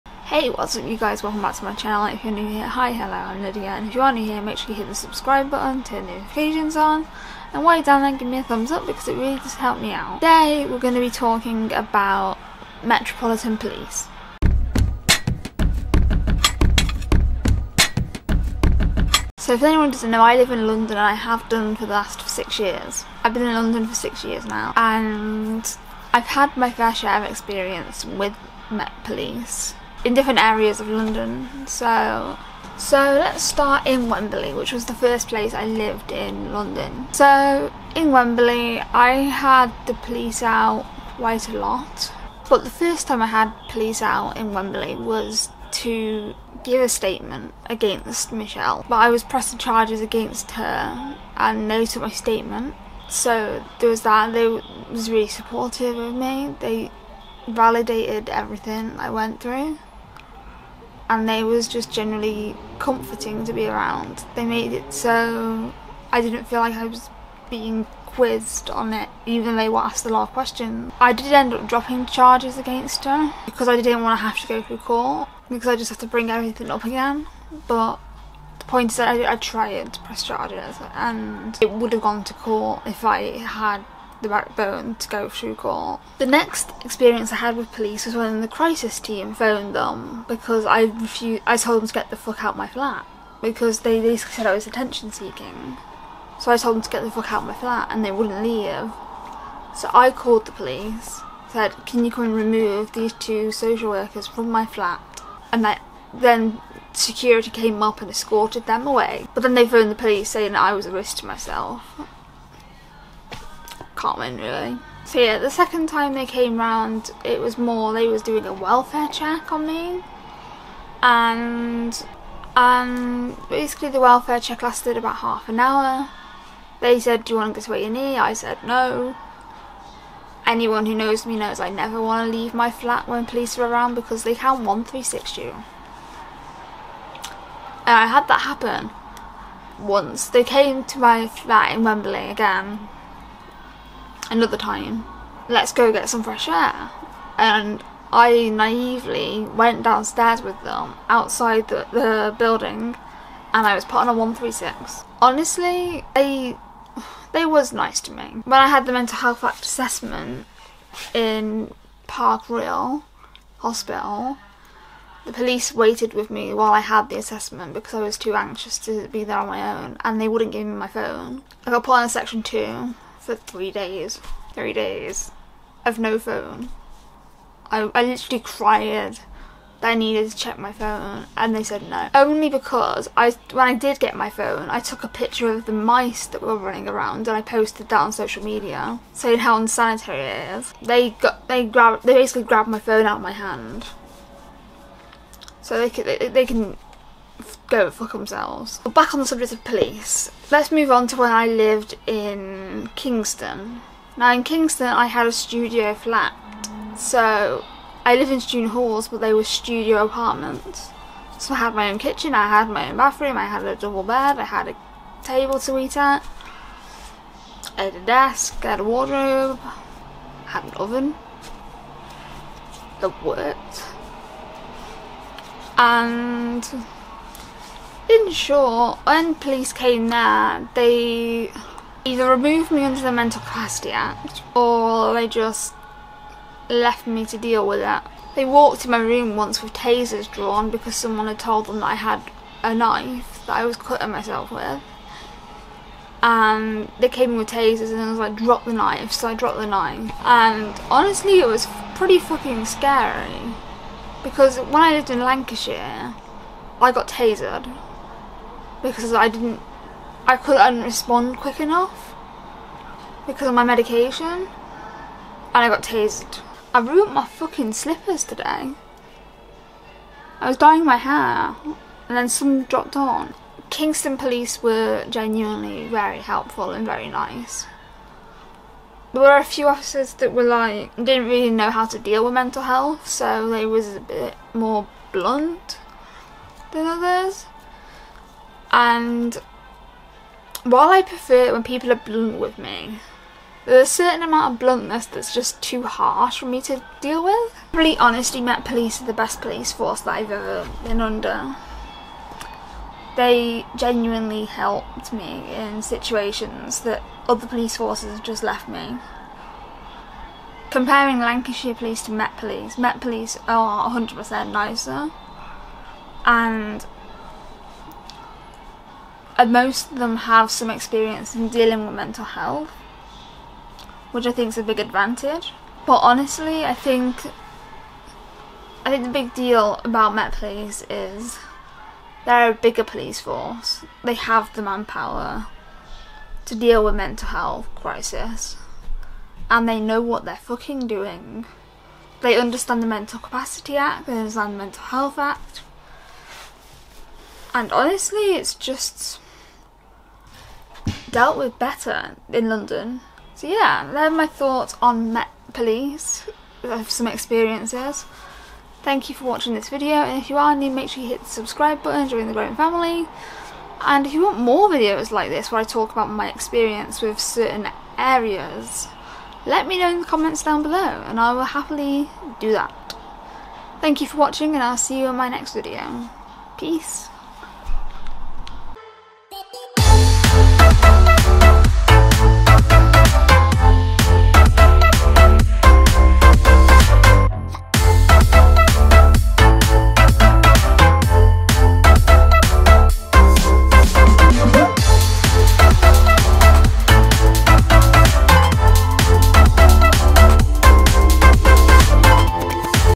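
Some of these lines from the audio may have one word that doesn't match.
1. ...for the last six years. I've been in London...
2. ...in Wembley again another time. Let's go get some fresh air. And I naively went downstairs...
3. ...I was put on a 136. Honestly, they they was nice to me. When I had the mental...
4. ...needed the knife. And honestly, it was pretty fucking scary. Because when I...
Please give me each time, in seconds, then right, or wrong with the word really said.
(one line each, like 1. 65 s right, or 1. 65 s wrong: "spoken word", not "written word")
1. 21 s right
2. 141 s right
3. 153 s right
4. 249 s wrong: "dropped", not "needed".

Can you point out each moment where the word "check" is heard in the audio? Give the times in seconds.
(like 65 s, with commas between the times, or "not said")
119 s, 124 s, 180 s.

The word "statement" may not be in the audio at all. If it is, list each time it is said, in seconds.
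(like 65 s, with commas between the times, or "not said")
46 s, 52 s.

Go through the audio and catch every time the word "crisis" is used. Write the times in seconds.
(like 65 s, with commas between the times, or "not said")
88 s, 337 s.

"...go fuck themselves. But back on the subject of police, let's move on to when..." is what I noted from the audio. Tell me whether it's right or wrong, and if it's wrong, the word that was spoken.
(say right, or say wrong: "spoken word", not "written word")
right.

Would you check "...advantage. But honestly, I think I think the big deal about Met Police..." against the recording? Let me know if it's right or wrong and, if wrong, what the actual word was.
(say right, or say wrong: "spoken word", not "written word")
right.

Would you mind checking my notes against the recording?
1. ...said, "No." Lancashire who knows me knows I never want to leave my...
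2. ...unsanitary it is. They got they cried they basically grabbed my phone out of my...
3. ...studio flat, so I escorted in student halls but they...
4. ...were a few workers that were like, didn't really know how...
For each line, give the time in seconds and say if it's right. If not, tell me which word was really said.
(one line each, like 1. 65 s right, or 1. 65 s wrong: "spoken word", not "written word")
1. 128 s wrong: "Anyone", not "Lancashire"
2. 189 s wrong: "grabbed", not "cried"
3. 205 s wrong: "lived", not "escorted"
4. 279 s wrong: "officers", not "workers".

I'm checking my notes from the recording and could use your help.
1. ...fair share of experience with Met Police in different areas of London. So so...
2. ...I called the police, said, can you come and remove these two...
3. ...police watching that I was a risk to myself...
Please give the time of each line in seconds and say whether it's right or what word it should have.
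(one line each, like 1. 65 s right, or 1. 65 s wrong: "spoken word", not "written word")
1. 26 s right
2. 99 s right
3. 109 s wrong: "saying", not "watching".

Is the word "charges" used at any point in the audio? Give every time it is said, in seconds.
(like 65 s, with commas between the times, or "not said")
49 s, 72 s, 80 s.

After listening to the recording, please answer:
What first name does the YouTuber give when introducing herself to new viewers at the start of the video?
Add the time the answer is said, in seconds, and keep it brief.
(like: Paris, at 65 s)
Lydia, at 3 s.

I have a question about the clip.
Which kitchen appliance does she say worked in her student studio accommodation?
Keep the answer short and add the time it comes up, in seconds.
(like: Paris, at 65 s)
Oven, at 220 s.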